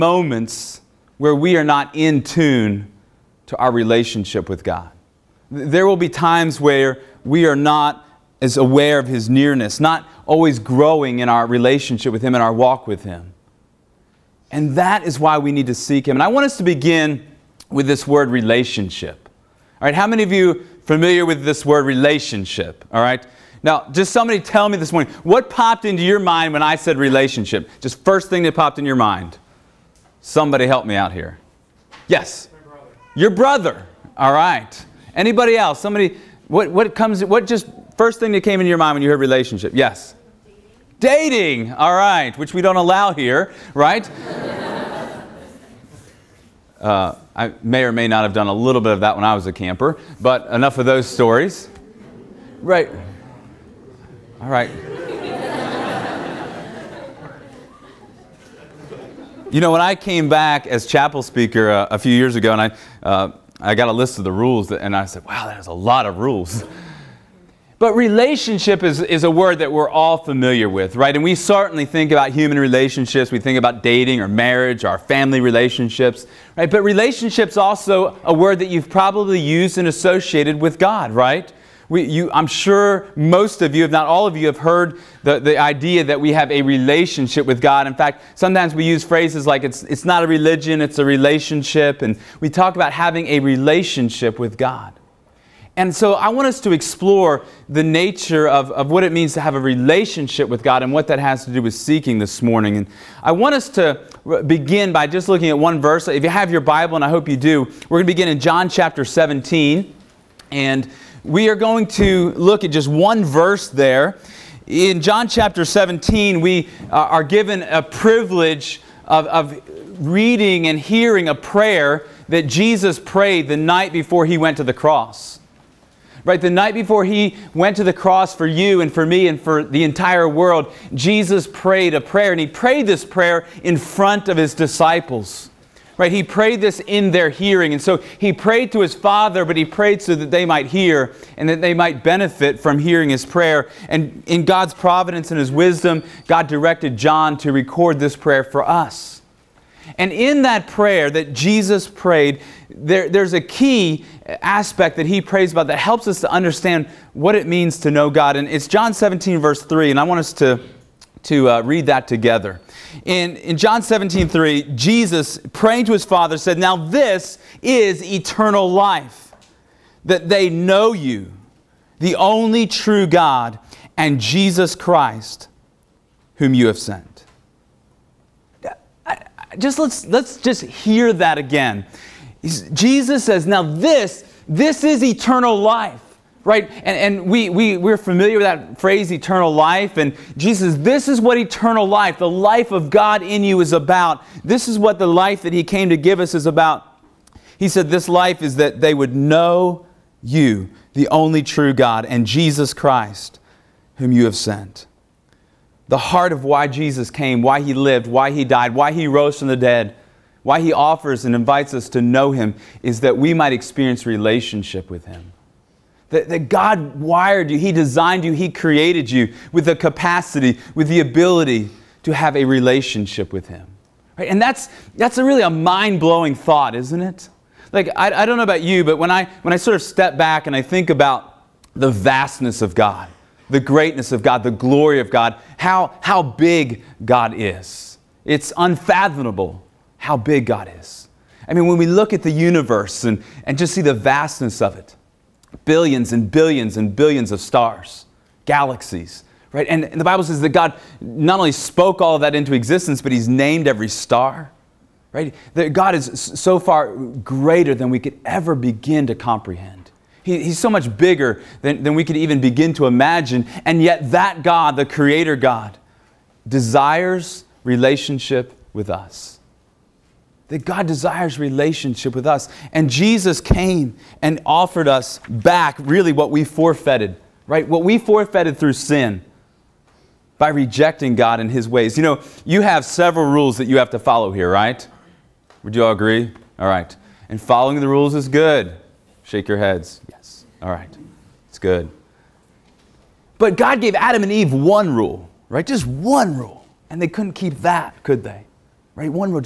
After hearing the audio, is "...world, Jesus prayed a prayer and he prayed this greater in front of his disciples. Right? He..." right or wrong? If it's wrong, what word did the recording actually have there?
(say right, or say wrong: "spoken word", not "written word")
wrong: "prayer", not "greater".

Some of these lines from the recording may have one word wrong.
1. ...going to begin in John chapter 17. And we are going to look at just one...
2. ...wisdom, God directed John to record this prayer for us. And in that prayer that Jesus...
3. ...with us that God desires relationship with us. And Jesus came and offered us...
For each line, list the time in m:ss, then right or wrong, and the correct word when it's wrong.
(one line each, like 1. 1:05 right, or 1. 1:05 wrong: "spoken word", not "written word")
1. 1:47 right
2. 2:25 right
3. 4:28 right.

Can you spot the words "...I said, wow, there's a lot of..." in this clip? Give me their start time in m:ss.
1:04.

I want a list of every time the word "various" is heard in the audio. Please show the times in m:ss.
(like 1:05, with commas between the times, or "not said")
not said.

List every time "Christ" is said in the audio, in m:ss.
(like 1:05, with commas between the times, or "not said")
2:54, 3:22.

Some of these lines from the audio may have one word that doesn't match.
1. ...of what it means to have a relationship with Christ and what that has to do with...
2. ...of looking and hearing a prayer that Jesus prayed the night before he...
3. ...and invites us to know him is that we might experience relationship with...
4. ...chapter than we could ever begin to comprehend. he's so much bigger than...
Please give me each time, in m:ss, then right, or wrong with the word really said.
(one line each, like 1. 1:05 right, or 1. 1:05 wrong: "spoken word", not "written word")
1. 1:38 wrong: "God", not "Christ"
2. 1:59 wrong: "reading", not "looking"
3. 3:31 right
4. 4:16 wrong: "greater", not "chapter".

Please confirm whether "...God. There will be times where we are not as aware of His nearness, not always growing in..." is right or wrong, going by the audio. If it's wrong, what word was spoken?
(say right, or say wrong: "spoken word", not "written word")
right.